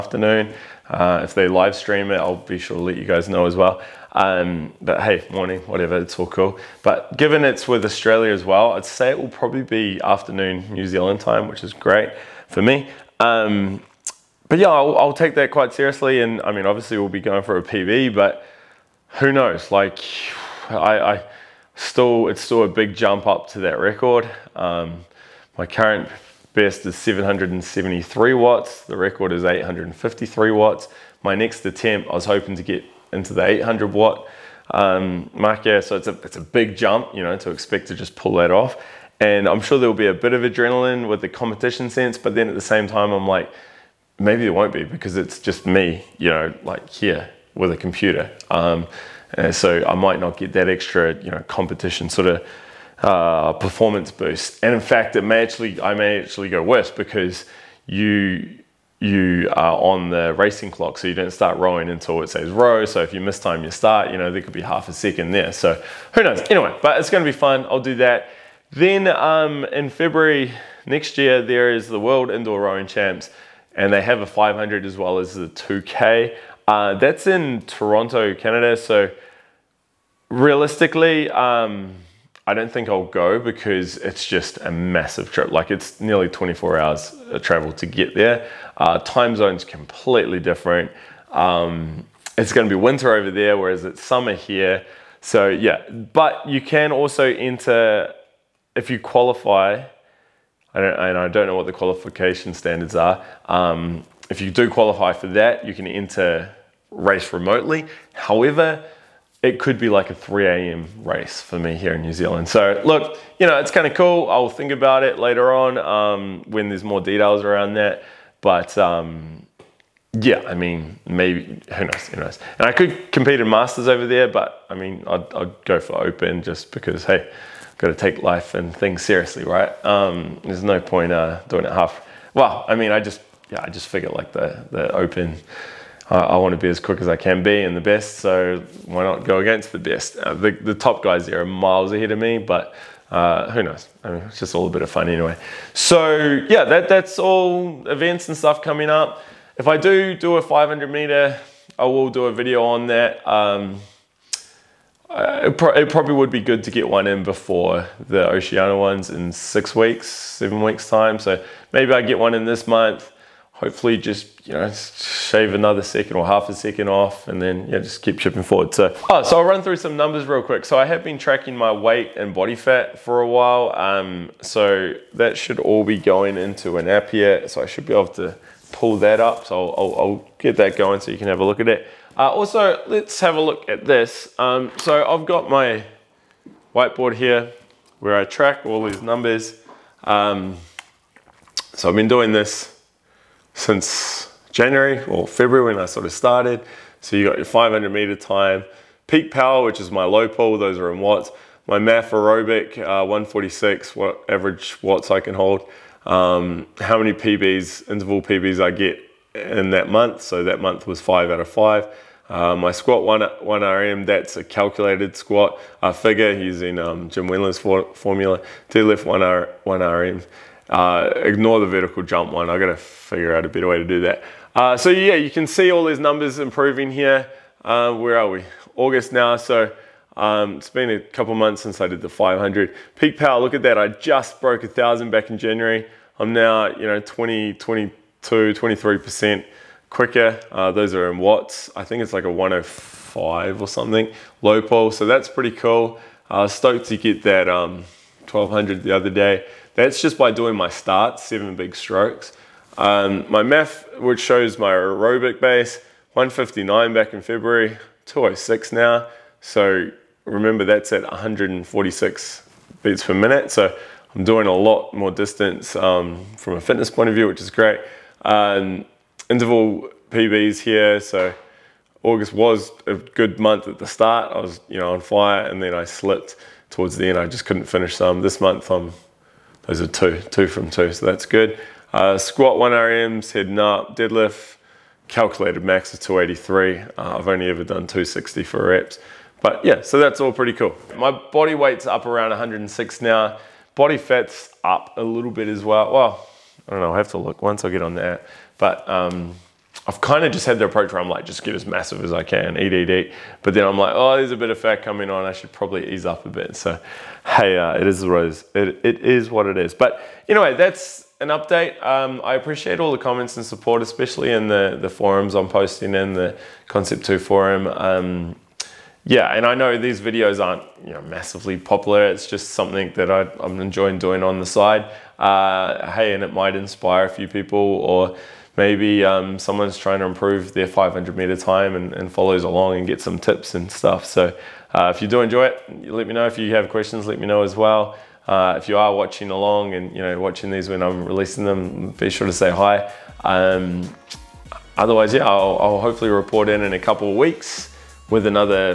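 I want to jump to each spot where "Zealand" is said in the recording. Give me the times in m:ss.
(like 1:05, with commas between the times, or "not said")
0:10, 1:52.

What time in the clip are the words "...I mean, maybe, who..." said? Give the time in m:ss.
2:00.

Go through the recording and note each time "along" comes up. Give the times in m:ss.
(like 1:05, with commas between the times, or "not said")
5:32, 5:39.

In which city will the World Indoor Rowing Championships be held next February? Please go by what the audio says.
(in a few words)
Toronto.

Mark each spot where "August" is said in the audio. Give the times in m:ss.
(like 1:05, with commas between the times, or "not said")
3:48, 4:32.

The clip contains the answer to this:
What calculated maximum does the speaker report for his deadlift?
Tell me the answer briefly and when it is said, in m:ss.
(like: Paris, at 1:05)
283, at 4:45.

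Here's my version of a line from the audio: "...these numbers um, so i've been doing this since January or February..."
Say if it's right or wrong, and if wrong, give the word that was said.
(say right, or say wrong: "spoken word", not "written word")
right.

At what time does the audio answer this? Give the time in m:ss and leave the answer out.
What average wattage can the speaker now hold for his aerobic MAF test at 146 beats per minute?
4:18.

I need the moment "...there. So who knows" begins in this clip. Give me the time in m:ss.
1:05.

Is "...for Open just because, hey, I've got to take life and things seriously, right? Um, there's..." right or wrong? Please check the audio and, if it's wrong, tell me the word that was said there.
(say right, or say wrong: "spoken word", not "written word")
right.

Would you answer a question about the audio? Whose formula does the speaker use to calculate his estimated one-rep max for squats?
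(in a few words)
Jim Wendler.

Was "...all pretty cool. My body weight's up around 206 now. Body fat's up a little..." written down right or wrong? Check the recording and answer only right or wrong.
wrong.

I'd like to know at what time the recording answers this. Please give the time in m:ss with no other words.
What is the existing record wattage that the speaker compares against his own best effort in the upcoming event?
0:29.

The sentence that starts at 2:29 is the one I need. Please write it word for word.
If I do do a 500 meter, I will do a video on that.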